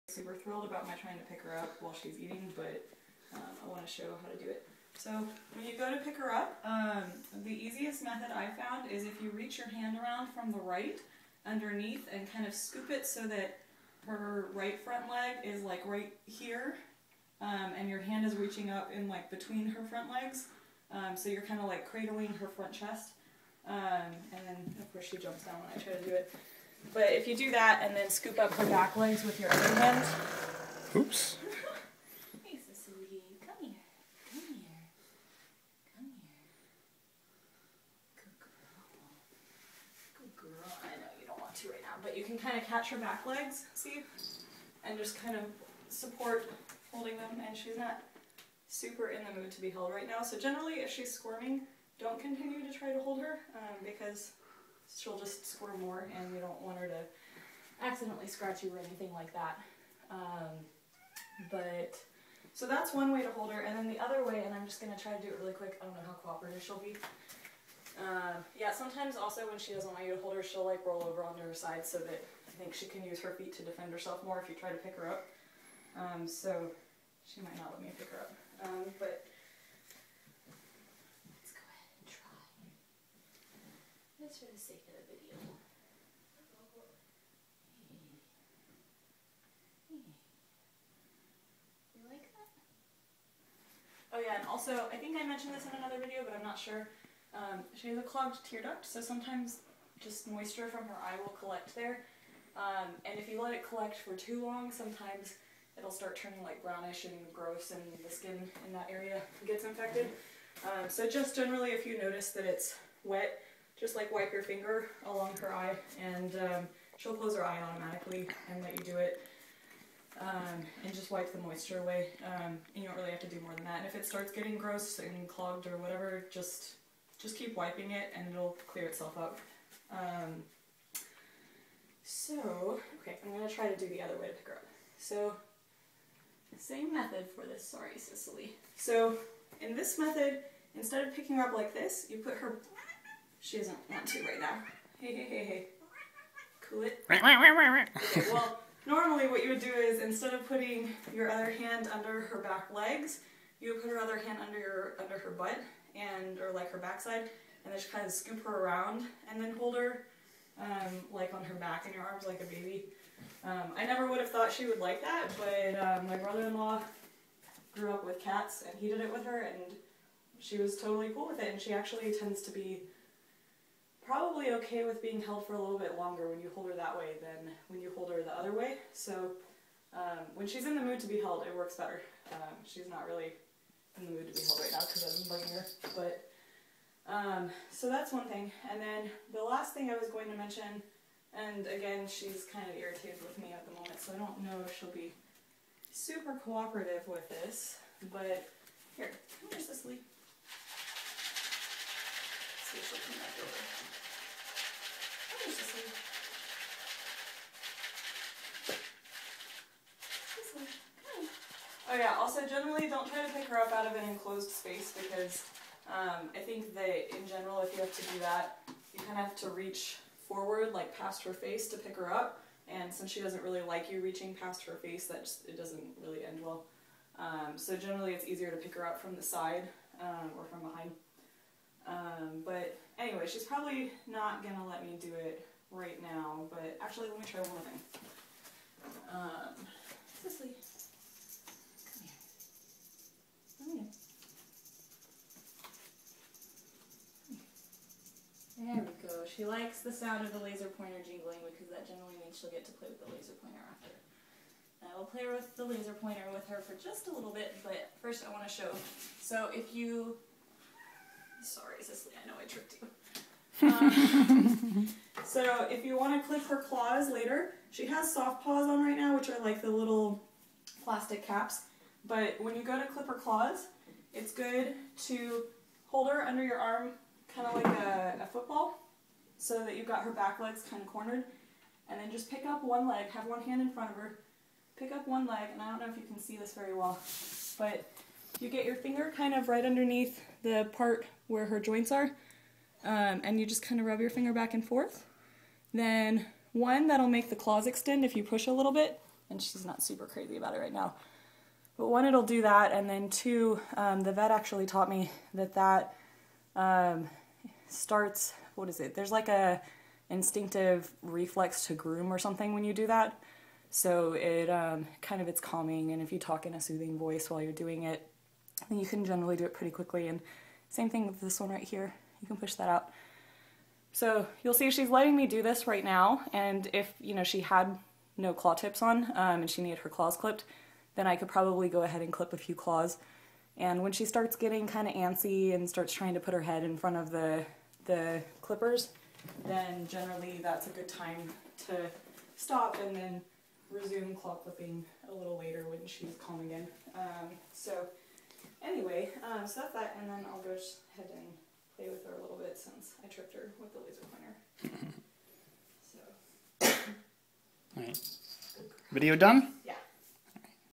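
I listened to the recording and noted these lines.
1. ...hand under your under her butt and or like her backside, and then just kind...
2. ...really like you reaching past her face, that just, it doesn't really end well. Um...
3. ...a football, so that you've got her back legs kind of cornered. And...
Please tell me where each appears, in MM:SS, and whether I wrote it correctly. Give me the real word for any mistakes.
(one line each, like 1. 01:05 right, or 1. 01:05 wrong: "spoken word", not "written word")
1. 02:34 right
2. 03:43 right
3. 04:38 right.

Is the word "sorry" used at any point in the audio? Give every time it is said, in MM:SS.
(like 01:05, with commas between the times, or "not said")
02:17, 04:21.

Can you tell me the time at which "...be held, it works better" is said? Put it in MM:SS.
03:01.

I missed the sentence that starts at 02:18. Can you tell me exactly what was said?
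so in this method instead of picking her up like this you put her she doesn't want to right now.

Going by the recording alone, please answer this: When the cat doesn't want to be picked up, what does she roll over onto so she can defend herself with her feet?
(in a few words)
her side.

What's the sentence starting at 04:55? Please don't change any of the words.
Then one, that'll make the claws extend if you push a little bit, and she's not super crazy about it right now.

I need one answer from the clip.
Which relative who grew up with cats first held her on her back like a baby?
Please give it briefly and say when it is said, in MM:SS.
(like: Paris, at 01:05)
brother-in-law, at 02:46.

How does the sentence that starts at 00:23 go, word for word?
Um, and then of course she jumps down when I try to do it.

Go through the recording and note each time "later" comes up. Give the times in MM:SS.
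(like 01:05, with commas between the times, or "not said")
04:27, 05:45.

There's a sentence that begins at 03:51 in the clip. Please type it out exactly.
Um, but anyway, she's probably not going to let me do it right now, but actually let me try one thing.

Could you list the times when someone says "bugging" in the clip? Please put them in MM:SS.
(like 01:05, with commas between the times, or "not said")
03:05.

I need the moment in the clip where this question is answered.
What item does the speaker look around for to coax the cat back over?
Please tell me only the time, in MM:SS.
03:19.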